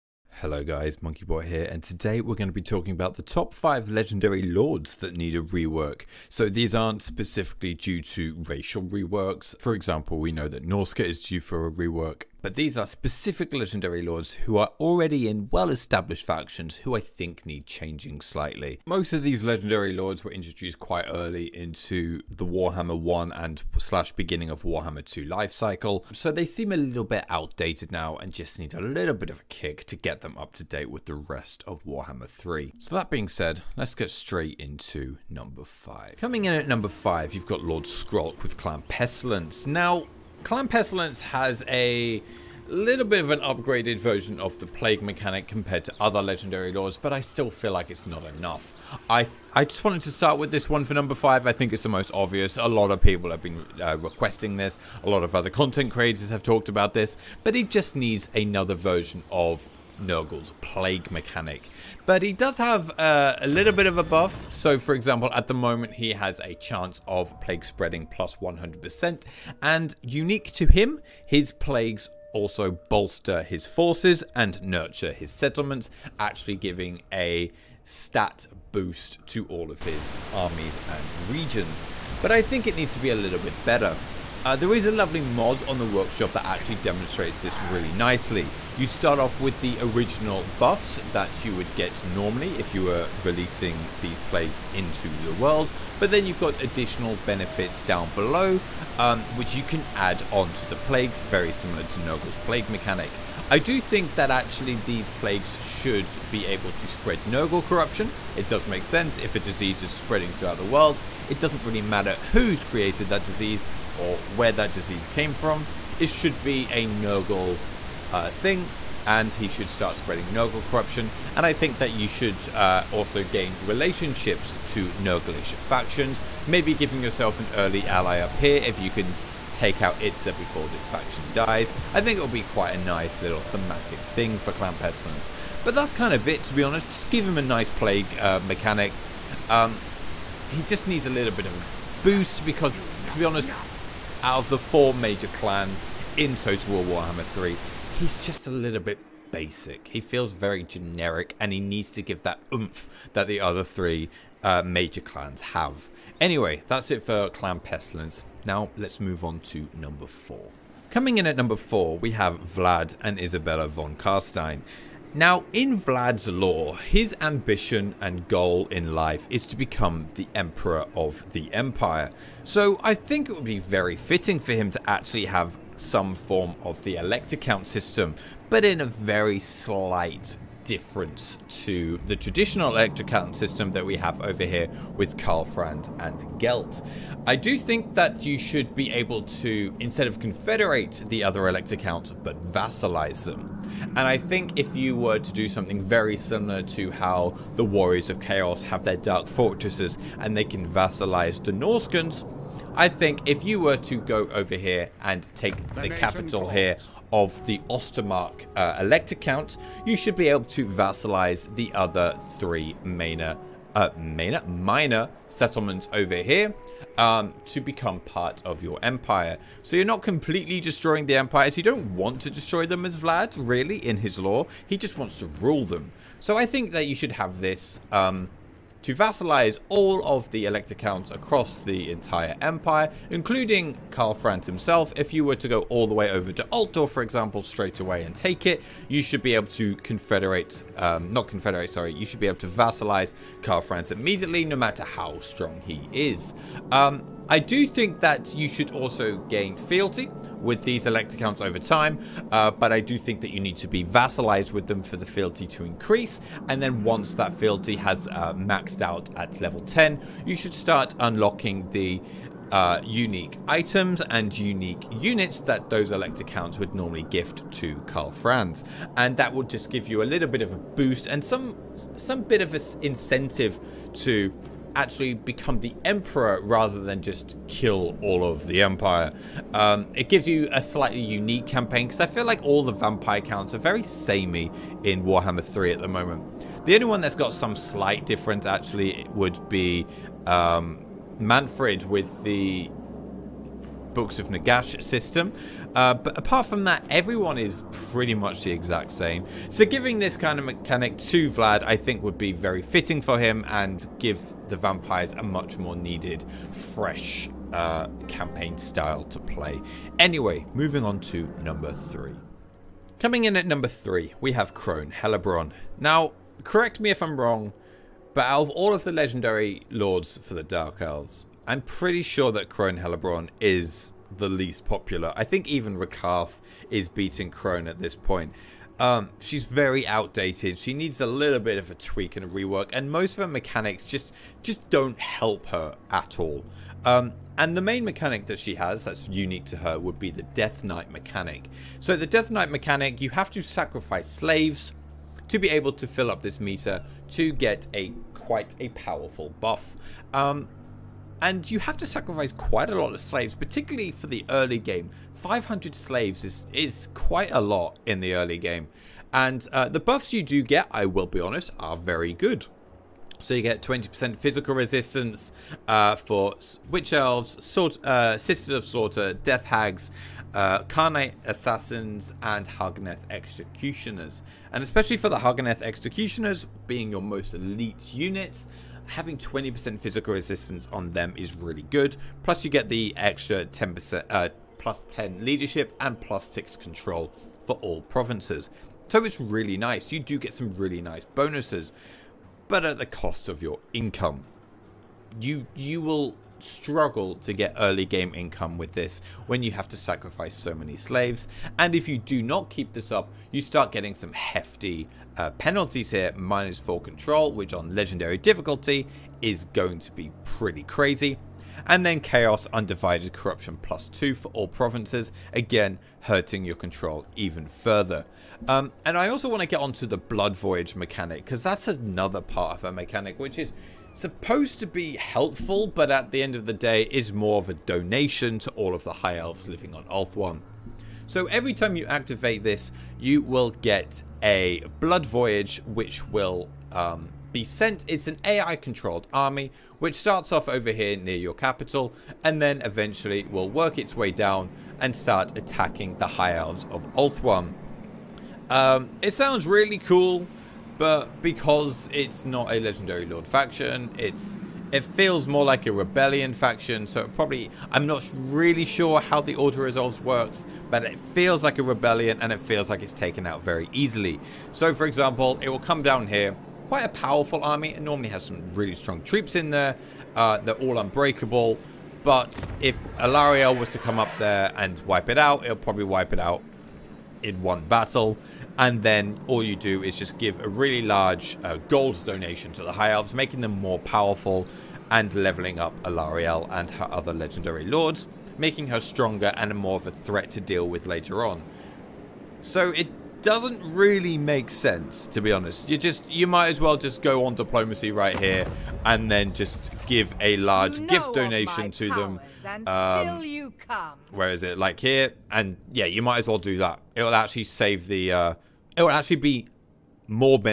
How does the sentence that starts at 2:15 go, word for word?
But that's kind of it, to be honest.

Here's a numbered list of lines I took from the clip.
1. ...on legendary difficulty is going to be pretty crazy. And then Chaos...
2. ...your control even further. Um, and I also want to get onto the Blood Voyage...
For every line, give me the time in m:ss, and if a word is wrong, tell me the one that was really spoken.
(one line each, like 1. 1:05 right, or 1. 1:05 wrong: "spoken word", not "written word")
1. 6:47 right
2. 6:56 right.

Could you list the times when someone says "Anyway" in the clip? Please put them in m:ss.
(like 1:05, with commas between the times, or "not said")
2:36, 5:09.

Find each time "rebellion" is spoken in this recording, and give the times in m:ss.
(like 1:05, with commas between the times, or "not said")
7:35, 7:41.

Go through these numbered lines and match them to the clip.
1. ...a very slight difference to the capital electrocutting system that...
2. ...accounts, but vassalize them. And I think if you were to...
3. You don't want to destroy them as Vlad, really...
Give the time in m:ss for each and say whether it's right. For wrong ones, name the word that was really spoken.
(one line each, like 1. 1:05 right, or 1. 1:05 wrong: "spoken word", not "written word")
1. 2:58 wrong: "traditional", not "capital"
2. 3:11 right
3. 3:41 right.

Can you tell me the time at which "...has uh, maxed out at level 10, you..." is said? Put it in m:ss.
4:17.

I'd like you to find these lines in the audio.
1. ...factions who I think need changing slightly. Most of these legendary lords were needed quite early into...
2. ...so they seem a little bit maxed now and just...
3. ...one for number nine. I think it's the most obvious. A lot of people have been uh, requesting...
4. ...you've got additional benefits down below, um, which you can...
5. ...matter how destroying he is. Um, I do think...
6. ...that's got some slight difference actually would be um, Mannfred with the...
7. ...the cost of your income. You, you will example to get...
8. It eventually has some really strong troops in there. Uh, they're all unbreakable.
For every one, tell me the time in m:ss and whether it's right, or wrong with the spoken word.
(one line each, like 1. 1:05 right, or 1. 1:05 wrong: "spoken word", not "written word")
1. 0:16 wrong: "introduced", not "needed"
2. 0:26 wrong: "outdated", not "maxed"
3. 0:50 wrong: "five", not "nine"
4. 1:36 right
5. 4:04 wrong: "strong", not "destroying"
6. 4:46 right
7. 6:32 wrong: "struggle", not "example"
8. 7:47 wrong: "normally", not "eventually".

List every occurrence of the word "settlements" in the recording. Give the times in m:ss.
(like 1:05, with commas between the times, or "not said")
1:15, 3:35.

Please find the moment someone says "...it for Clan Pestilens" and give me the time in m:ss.
2:36.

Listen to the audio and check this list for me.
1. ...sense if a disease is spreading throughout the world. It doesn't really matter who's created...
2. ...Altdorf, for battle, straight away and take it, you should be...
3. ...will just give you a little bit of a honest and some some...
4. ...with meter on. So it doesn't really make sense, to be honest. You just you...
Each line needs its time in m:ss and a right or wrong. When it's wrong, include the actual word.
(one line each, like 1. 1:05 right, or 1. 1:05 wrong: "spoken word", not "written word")
1. 1:48 right
2. 3:56 wrong: "example", not "battle"
3. 4:29 wrong: "boost", not "honest"
4. 8:10 wrong: "later", not "meter".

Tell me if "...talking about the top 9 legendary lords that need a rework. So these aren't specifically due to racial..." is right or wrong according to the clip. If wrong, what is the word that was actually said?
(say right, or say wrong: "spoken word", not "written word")
wrong: "5", not "9".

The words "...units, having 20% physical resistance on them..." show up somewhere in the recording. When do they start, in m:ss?
6:17.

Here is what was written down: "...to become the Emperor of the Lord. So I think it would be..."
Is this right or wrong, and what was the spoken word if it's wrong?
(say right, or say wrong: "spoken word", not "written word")
wrong: "Empire", not "Lord".